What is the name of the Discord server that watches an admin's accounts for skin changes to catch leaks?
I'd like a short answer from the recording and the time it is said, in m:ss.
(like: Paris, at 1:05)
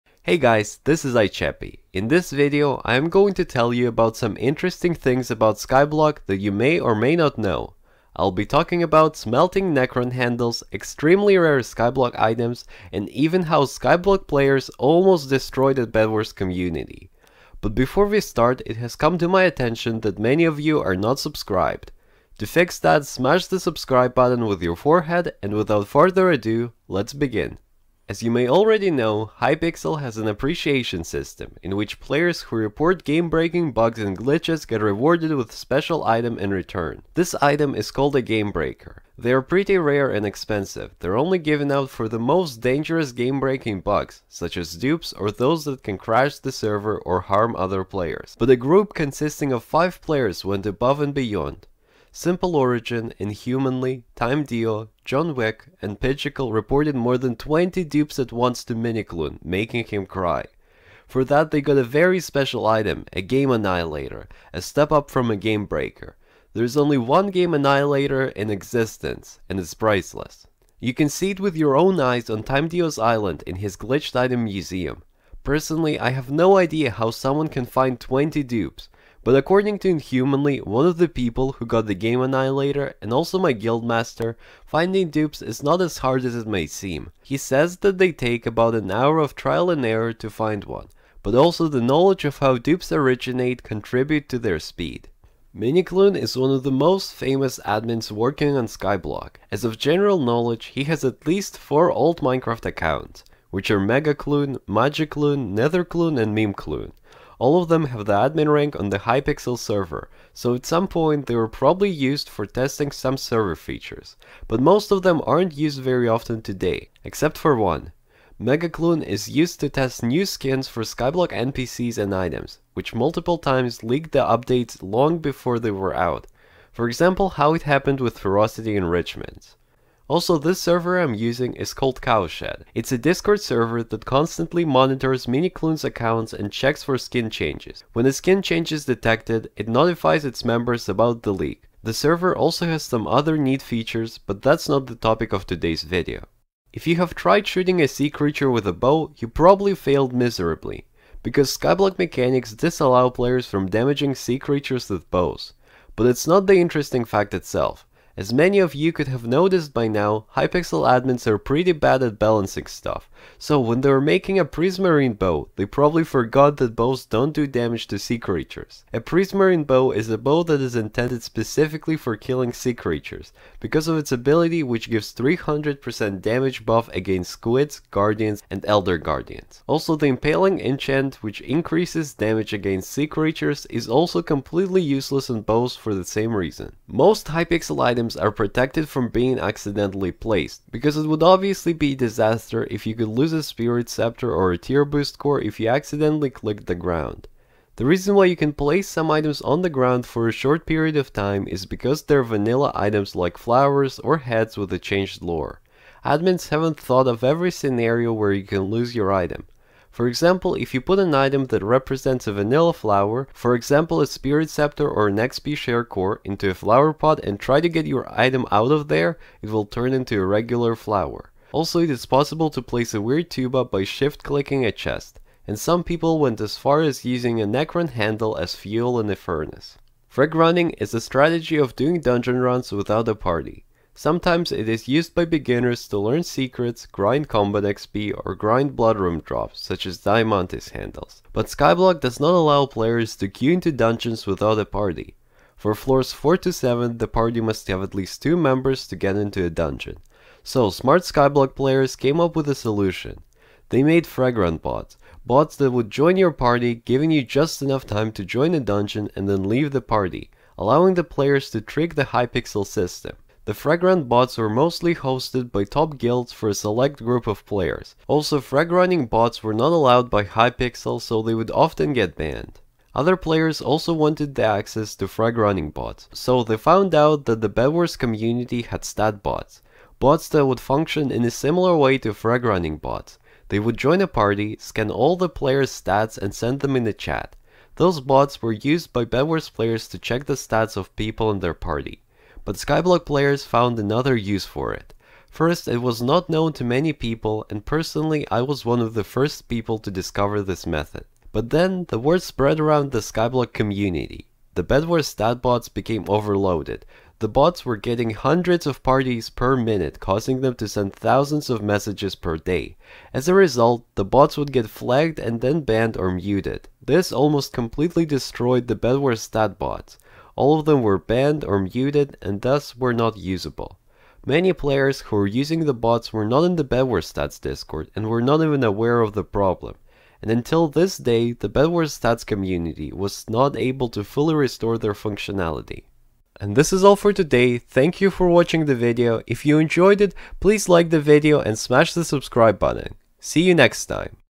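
Cowshed, at 2:12.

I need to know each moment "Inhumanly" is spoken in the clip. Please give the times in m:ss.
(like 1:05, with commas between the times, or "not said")
0:53, 1:19.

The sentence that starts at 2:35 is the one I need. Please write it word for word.
But it's not the interesting fact itself.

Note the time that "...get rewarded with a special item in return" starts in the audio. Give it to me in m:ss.
0:34.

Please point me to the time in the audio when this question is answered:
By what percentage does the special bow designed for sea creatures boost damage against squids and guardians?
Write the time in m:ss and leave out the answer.
2:55.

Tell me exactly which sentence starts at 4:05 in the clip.
For floors 4 to 7, the party must have at least 2 members to get into a dungeon.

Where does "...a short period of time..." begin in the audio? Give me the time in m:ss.
3:20.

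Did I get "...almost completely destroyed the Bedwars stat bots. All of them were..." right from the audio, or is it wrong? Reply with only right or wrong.
right.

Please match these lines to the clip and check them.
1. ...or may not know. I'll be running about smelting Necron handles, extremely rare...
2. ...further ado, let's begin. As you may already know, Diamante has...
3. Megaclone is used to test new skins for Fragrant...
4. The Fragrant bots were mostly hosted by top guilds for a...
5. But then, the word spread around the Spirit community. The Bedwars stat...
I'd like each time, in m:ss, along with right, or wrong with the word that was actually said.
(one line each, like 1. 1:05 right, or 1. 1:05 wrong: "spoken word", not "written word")
1. 0:06 wrong: "talking", not "running"
2. 0:25 wrong: "Hypixel", not "Diamante"
3. 1:58 wrong: "Skyblock", not "Fragrant"
4. 4:23 right
5. 5:01 wrong: "Skyblock", not "Spirit".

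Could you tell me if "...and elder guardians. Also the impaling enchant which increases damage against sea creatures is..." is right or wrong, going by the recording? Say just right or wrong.
right.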